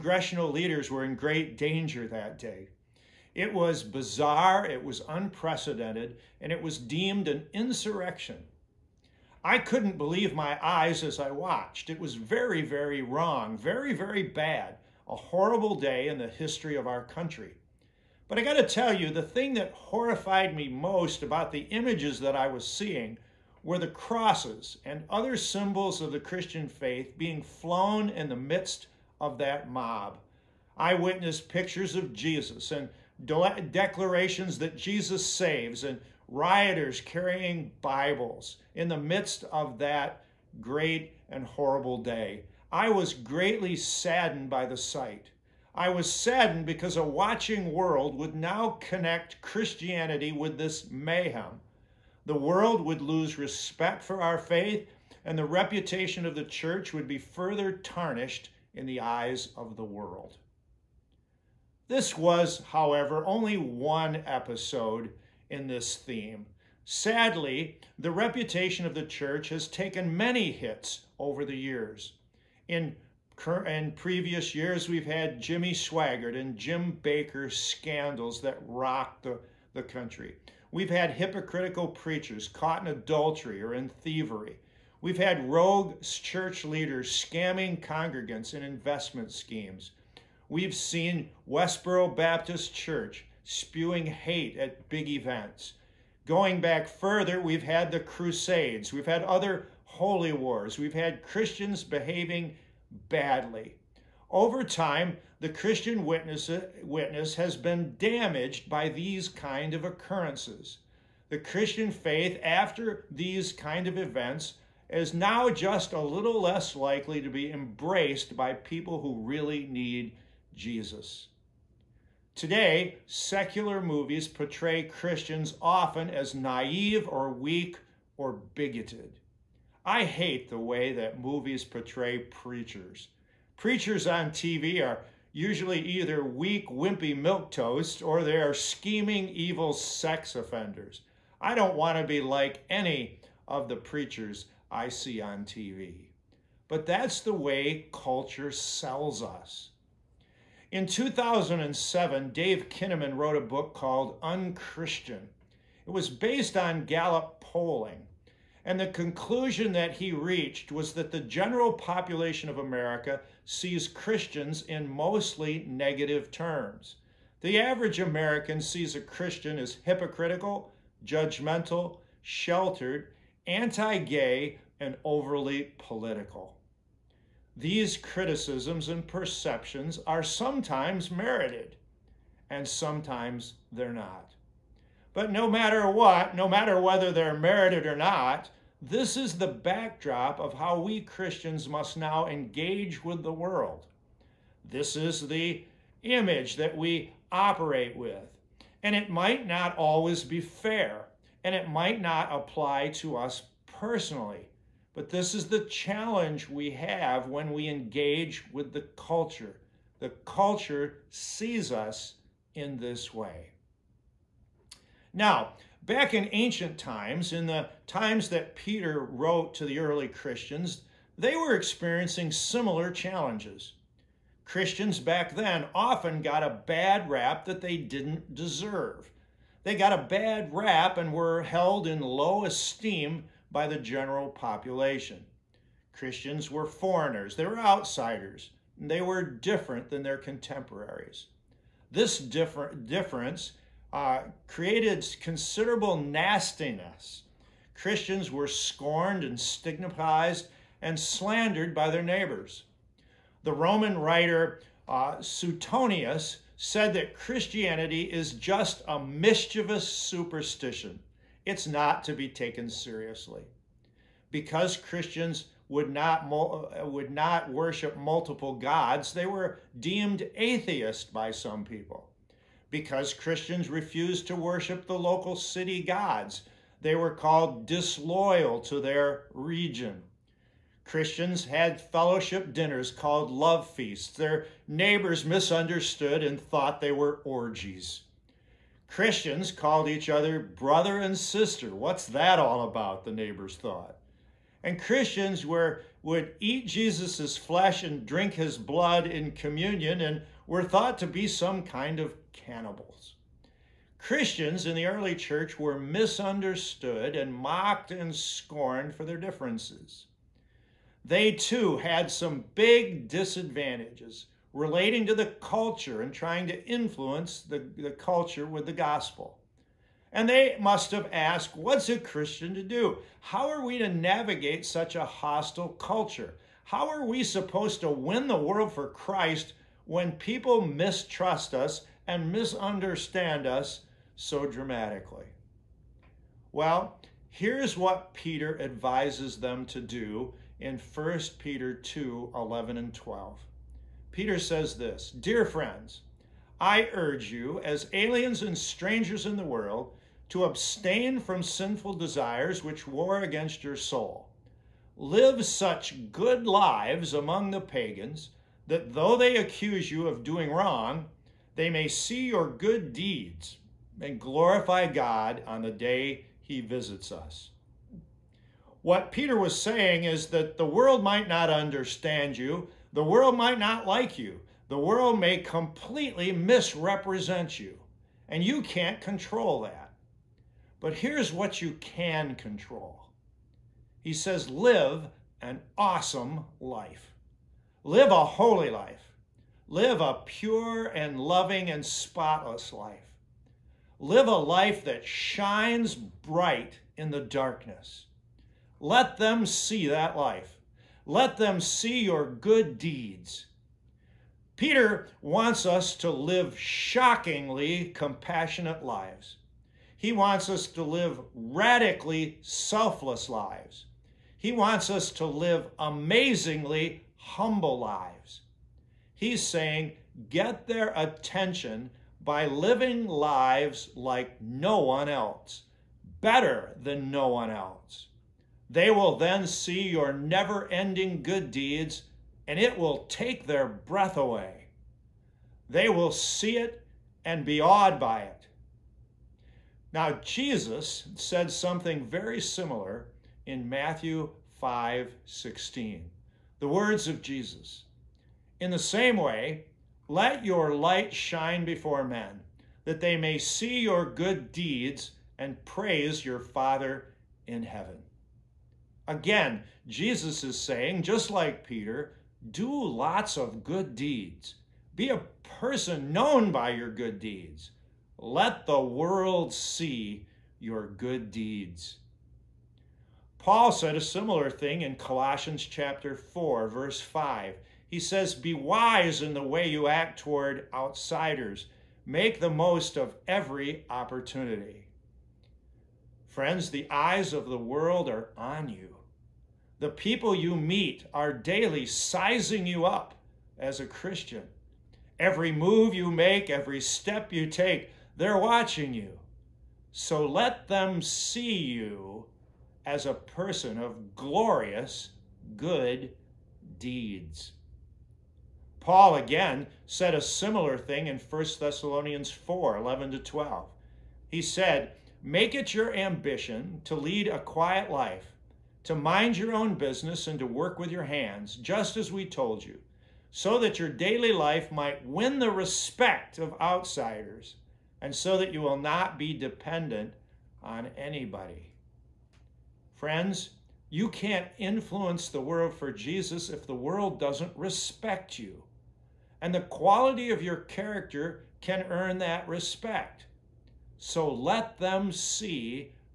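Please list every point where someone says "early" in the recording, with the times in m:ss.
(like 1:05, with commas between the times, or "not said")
3:39, 5:04.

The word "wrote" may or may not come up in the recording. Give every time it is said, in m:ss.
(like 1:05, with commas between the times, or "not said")
2:33, 3:38.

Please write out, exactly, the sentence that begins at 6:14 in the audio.
The world may completely misrepresent you, and you can't control that.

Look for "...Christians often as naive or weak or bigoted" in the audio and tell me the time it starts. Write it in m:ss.
2:04.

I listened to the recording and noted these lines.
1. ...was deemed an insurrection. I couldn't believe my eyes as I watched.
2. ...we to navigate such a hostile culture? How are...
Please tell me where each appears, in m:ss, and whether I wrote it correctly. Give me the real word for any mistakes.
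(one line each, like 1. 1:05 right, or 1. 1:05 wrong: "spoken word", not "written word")
1. 0:06 right
2. 5:23 right.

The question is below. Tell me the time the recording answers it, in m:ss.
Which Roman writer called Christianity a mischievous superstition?
4:15.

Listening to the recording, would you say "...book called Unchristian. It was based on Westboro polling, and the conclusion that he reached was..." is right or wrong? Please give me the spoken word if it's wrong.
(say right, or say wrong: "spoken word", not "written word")
wrong: "Gallup", not "Westboro".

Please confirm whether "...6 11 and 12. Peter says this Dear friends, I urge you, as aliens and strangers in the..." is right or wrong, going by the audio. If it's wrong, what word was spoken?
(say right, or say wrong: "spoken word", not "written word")
wrong: "2", not "6".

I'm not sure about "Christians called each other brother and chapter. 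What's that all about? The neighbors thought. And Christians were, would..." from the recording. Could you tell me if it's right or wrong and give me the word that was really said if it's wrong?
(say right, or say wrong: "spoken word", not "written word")
wrong: "sister", not "chapter".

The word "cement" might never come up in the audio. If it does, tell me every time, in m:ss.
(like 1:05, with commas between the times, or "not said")
not said.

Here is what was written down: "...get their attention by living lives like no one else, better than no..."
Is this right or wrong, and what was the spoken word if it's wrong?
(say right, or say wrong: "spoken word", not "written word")
right.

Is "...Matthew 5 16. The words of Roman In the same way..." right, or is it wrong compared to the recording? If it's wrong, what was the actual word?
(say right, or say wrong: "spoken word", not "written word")
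wrong: "Jesus", not "Roman".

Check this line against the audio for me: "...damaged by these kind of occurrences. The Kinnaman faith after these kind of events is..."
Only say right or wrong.
wrong.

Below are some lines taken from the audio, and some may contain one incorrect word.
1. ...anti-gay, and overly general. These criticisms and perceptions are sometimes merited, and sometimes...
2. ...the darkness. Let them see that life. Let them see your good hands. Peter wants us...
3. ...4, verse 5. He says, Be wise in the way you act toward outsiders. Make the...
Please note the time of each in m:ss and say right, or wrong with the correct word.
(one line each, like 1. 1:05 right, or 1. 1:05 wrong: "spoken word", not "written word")
1. 2:53 wrong: "political", not "general"
2. 6:37 wrong: "deeds", not "hands"
3. 7:56 right.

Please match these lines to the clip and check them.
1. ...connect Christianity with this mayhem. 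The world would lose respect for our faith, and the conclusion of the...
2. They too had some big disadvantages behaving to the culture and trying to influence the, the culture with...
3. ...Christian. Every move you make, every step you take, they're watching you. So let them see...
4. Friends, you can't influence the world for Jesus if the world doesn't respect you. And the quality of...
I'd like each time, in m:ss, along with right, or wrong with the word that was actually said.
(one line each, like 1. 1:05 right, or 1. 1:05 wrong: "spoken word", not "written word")
1. 0:48 wrong: "reputation", not "conclusion"
2. 5:11 wrong: "relating", not "behaving"
3. 8:13 right
4. 8:52 right.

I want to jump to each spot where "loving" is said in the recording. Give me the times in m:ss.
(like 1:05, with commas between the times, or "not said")
6:31.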